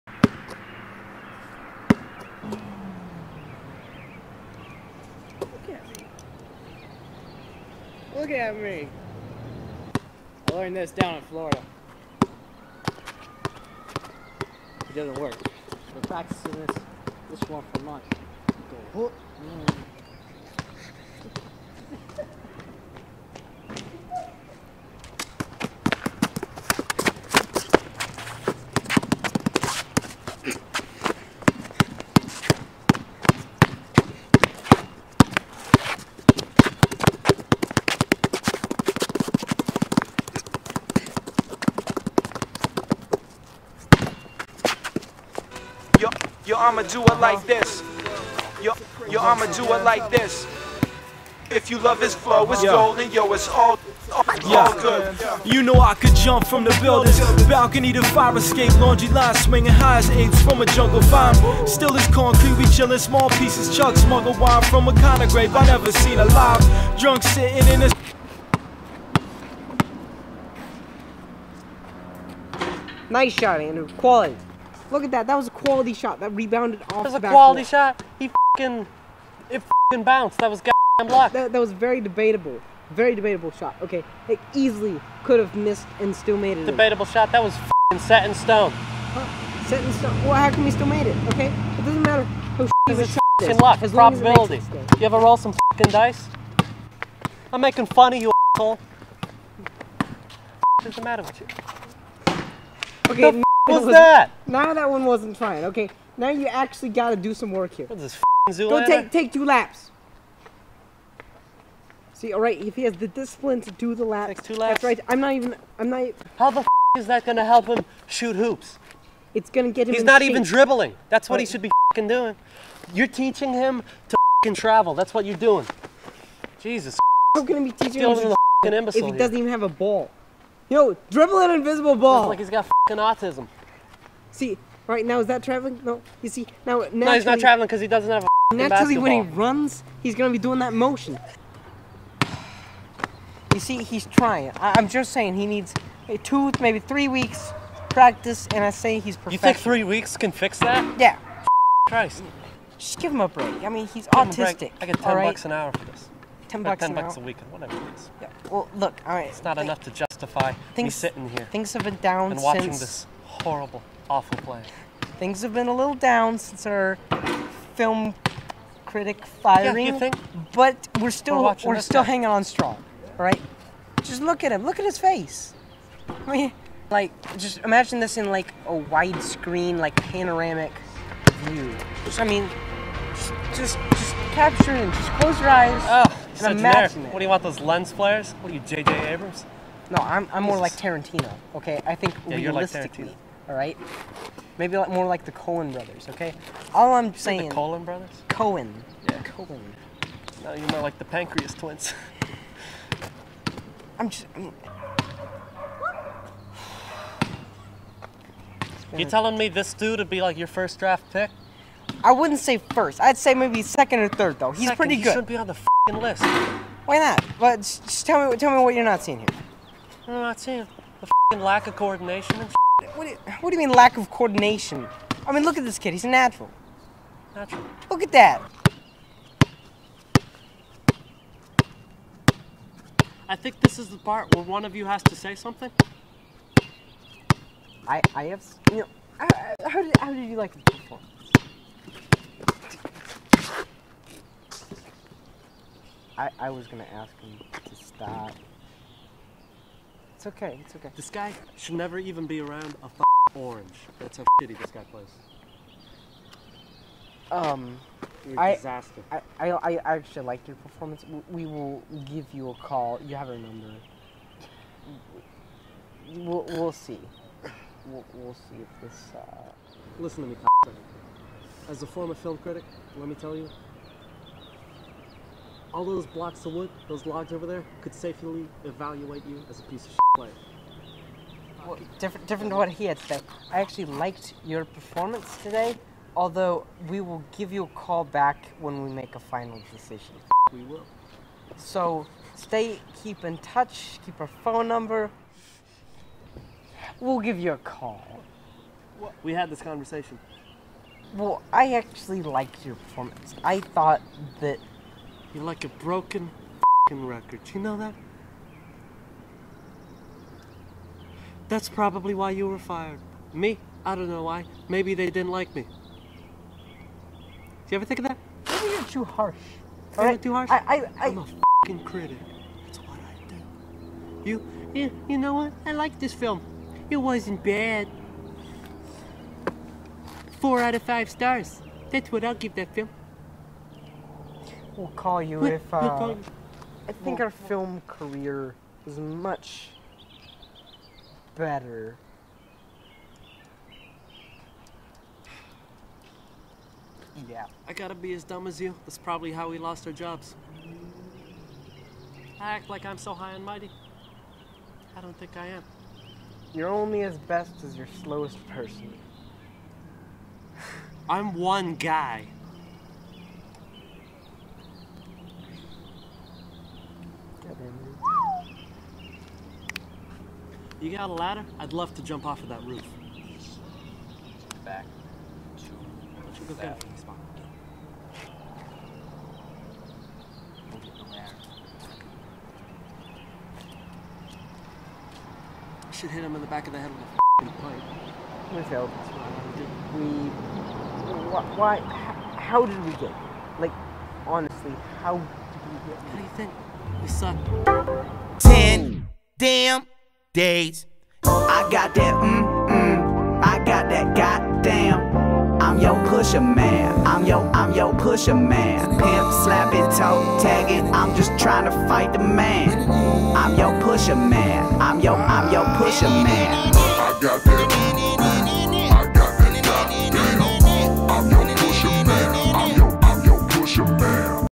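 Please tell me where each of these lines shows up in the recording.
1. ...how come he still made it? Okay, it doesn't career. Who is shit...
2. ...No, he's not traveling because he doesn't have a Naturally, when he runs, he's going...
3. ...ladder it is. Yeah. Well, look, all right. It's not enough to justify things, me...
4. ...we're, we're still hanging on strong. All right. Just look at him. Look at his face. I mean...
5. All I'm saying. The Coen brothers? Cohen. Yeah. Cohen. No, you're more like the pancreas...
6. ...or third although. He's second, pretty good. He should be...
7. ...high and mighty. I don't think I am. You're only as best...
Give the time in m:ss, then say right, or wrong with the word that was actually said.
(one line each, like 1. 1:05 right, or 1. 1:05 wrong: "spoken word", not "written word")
1. 1:30 wrong: "matter", not "career"
2. 2:16 right
3. 2:37 wrong: "whatever", not "ladder"
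4. 2:51 right
5. 3:16 right
6. 3:34 wrong: "though", not "although"
7. 5:53 right.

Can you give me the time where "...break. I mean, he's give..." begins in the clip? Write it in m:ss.
2:33.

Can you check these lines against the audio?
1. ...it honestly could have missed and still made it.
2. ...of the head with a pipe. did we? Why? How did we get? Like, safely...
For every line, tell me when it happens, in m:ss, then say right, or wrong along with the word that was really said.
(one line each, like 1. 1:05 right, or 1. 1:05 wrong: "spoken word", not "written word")
1. 1:24 wrong: "easily", not "honestly"
2. 6:26 wrong: "honestly", not "safely".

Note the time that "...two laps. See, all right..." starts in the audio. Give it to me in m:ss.
1:49.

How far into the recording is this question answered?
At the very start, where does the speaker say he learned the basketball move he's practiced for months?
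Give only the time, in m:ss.
0:11.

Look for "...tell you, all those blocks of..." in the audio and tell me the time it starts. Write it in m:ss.
4:33.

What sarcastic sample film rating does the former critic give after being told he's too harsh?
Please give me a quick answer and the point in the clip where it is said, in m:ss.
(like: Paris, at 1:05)
4 out of 5 stars, at 5:30.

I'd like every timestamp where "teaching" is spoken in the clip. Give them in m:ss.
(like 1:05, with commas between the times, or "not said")
2:03, 2:07.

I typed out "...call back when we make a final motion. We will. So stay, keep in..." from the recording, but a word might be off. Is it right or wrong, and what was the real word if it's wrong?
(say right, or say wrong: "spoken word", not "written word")
wrong: "decision", not "motion".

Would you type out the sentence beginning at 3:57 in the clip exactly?
I, I have, you know, I, how, did, how did you like the performance?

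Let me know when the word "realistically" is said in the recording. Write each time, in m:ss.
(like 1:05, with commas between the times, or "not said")
3:12.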